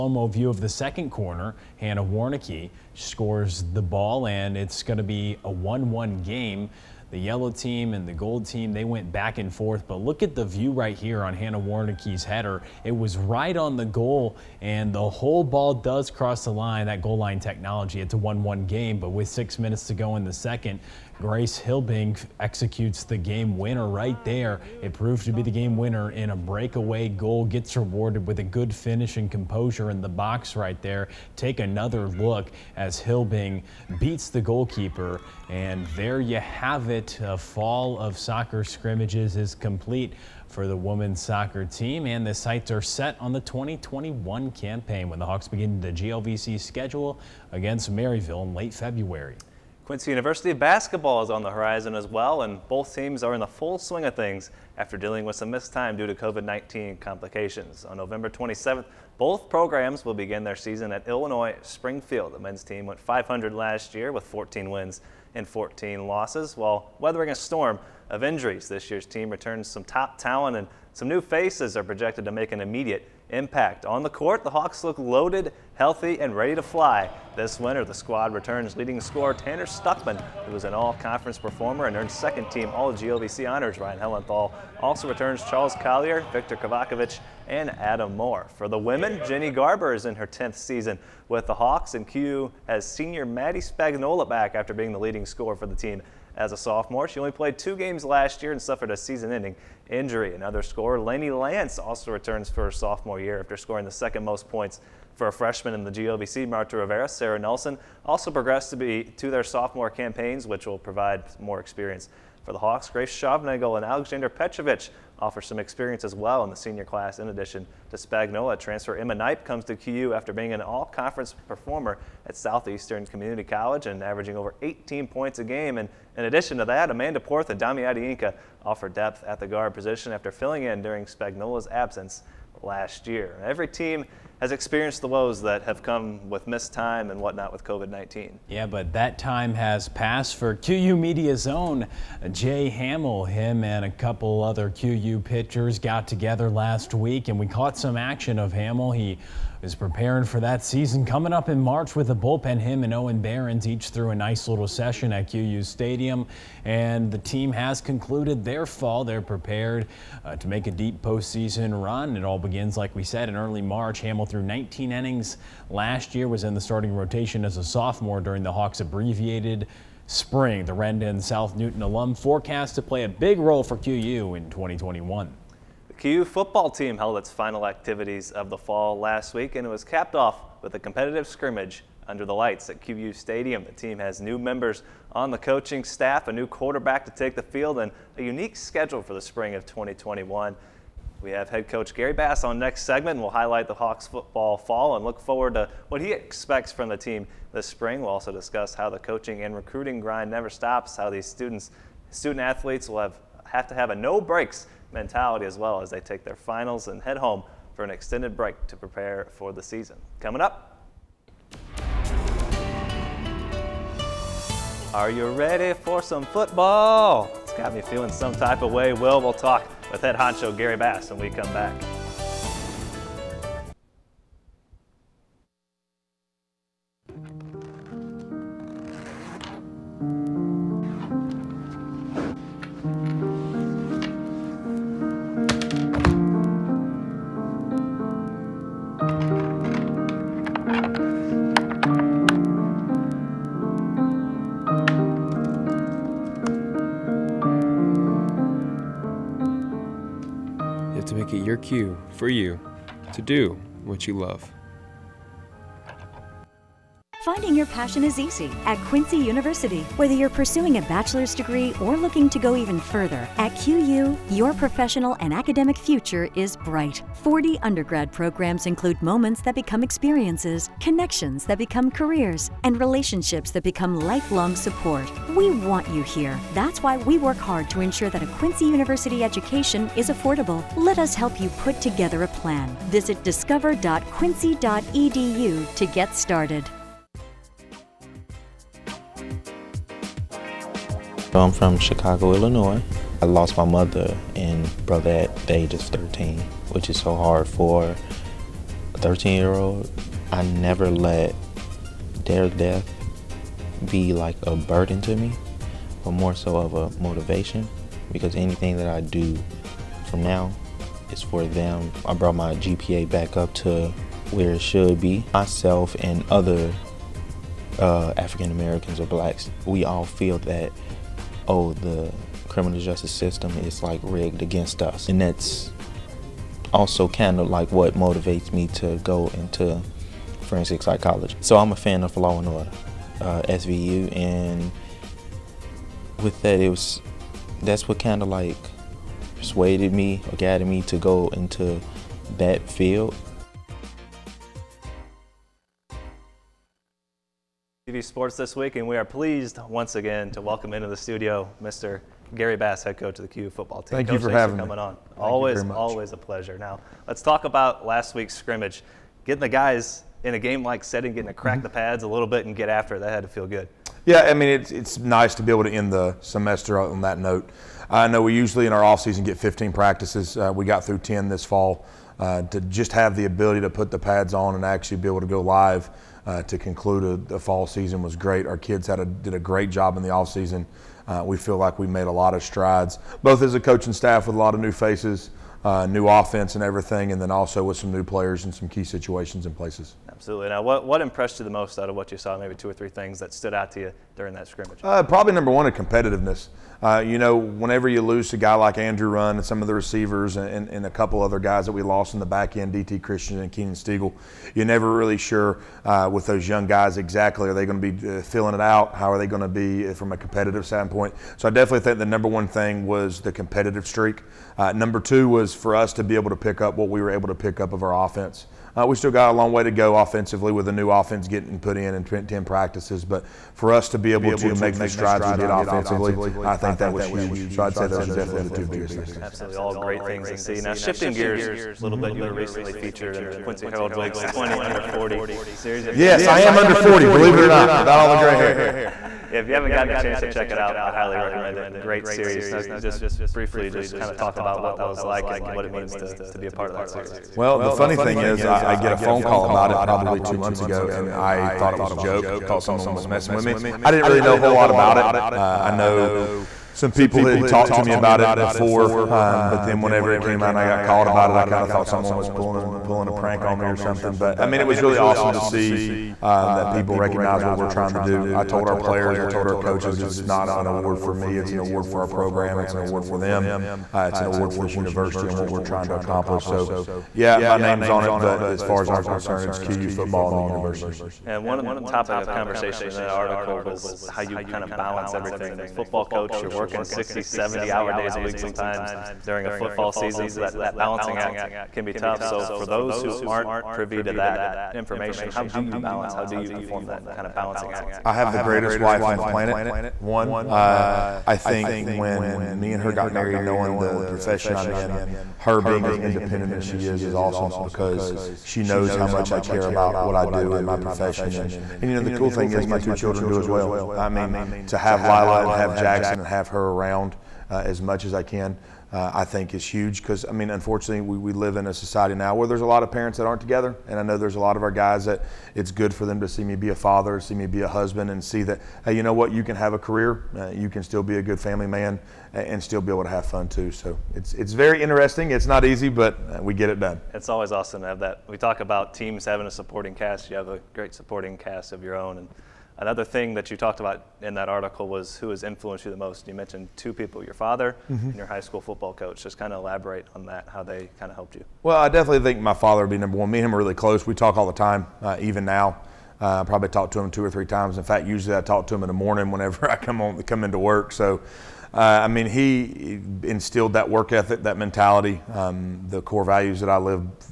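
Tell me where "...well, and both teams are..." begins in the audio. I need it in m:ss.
0:52.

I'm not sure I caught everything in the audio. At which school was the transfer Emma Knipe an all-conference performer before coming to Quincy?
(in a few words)
Southeastern Community College.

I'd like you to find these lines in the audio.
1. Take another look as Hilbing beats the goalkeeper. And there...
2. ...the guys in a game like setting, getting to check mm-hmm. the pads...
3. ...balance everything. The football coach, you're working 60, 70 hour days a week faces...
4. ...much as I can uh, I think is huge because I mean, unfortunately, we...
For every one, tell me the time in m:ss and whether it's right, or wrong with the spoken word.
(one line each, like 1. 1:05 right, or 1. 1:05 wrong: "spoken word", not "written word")
1. 0:31 right
2. 5:59 wrong: "crack", not "check"
3. 8:04 wrong: "sometimes", not "faces"
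4. 8:37 right.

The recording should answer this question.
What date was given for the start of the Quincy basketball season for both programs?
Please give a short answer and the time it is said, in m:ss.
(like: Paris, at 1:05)
November 27, at 0:57.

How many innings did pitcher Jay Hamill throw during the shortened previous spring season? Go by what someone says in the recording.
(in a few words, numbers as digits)
19.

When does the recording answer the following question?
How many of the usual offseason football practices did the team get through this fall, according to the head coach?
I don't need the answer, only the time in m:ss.
6:10.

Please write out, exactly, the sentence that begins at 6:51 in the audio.
So I definitely think the number one thing was the competitive streak.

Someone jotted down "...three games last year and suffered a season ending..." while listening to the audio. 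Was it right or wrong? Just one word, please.
wrong.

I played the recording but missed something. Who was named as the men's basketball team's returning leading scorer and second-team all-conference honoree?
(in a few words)
Tanner Stuckman.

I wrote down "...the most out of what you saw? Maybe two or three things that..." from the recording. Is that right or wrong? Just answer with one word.
right.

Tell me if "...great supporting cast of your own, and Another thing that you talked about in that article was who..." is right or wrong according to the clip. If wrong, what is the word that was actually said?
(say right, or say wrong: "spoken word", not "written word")
right.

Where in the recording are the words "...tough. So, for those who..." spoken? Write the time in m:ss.
8:11.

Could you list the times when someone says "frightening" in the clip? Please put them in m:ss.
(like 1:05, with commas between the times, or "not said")
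not said.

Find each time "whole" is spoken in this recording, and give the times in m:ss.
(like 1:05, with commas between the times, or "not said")
0:15, 7:34.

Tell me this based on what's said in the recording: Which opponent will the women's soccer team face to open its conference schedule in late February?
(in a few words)
Maryville.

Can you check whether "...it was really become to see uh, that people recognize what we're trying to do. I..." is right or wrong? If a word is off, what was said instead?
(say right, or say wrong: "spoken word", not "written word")
wrong: "awesome", not "become".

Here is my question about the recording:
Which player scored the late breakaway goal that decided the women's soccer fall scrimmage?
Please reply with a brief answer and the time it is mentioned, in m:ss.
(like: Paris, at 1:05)
Grace Hilbink, at 0:21.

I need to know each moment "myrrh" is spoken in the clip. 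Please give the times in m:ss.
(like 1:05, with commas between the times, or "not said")
not said.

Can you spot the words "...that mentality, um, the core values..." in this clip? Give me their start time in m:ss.
9:24.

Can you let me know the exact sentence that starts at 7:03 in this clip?
But for us to be able to make the strides we did offensively, I think that was huge.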